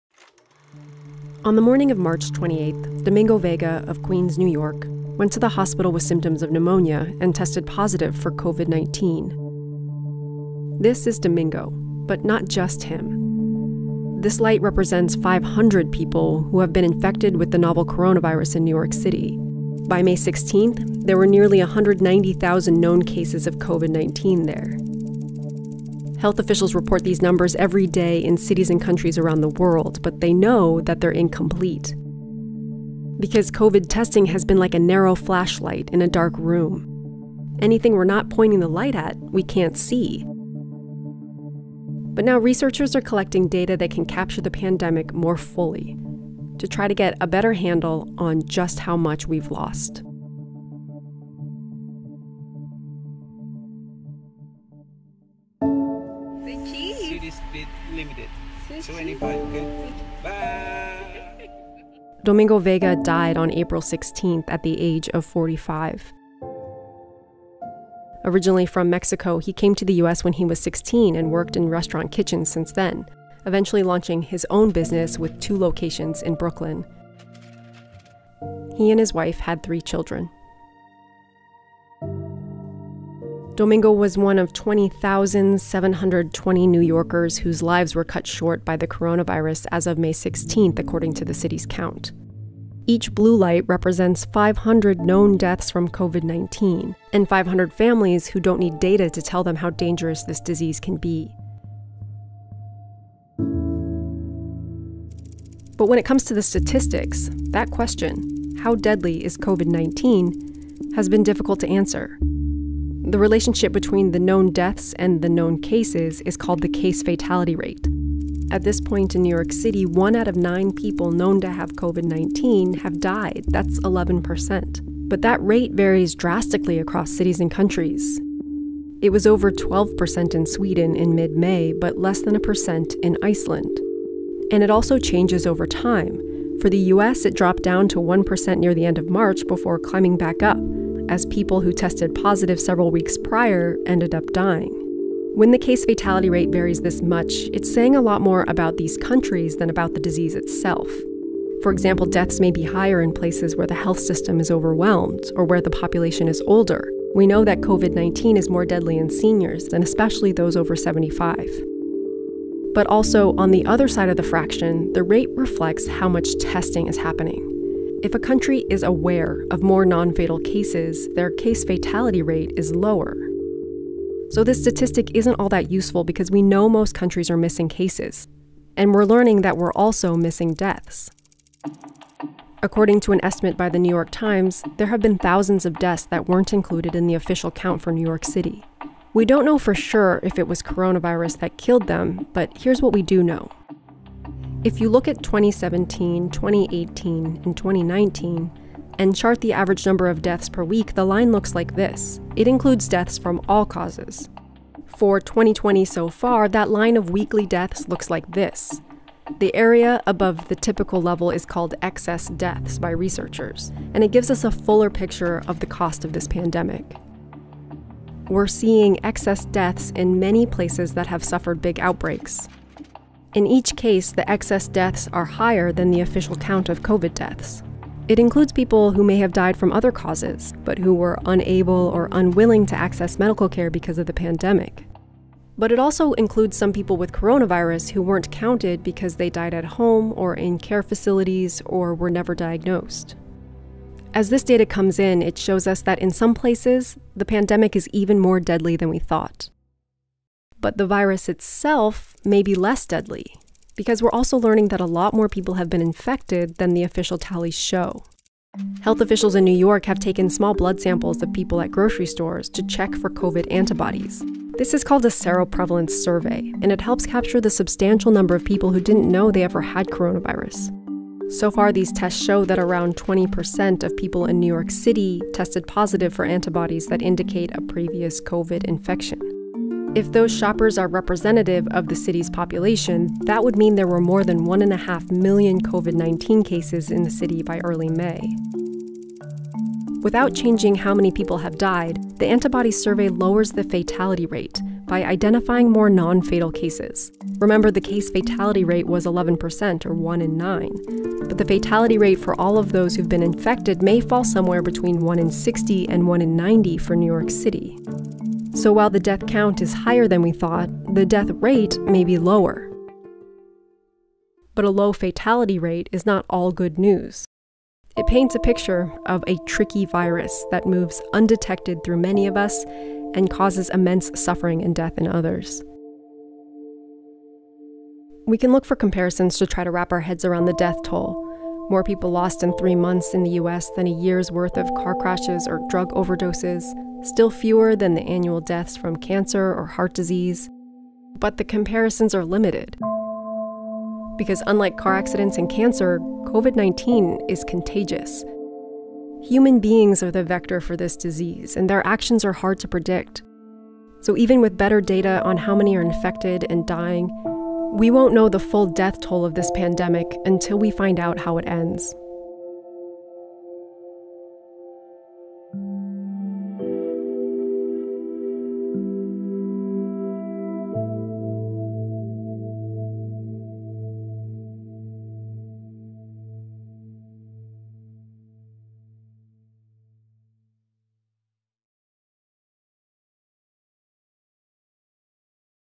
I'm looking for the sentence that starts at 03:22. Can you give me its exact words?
It includes deaths from all causes.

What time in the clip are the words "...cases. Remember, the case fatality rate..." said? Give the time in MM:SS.
04:56.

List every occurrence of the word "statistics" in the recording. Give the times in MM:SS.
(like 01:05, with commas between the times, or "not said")
01:46, 02:54.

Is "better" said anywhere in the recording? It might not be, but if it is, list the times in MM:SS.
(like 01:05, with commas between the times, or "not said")
00:47, 05:54.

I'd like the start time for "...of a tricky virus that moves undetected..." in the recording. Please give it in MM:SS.
05:19.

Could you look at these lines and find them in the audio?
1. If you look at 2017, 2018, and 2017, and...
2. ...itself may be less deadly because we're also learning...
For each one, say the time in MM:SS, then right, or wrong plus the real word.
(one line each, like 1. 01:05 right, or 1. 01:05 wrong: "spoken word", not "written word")
1. 03:14 wrong: "2019", not "2017"
2. 04:11 right.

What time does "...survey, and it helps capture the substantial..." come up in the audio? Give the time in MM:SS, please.
04:25.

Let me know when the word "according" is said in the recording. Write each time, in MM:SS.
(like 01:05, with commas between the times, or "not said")
01:30, 03:02.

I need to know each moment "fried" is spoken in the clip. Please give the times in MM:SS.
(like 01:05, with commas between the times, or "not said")
not said.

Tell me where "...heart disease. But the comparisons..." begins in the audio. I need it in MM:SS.
05:39.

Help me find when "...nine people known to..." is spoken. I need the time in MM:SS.
02:00.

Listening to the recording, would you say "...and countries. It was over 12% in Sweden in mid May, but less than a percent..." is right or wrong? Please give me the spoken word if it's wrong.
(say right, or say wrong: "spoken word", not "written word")
right.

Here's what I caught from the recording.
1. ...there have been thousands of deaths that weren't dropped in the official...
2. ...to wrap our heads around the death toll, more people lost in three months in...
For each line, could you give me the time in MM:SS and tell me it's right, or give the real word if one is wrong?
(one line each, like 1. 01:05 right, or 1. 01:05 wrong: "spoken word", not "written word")
1. 03:04 wrong: "included", not "dropped"
2. 05:29 right.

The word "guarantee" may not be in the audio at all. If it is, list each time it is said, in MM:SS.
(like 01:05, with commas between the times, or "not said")
not said.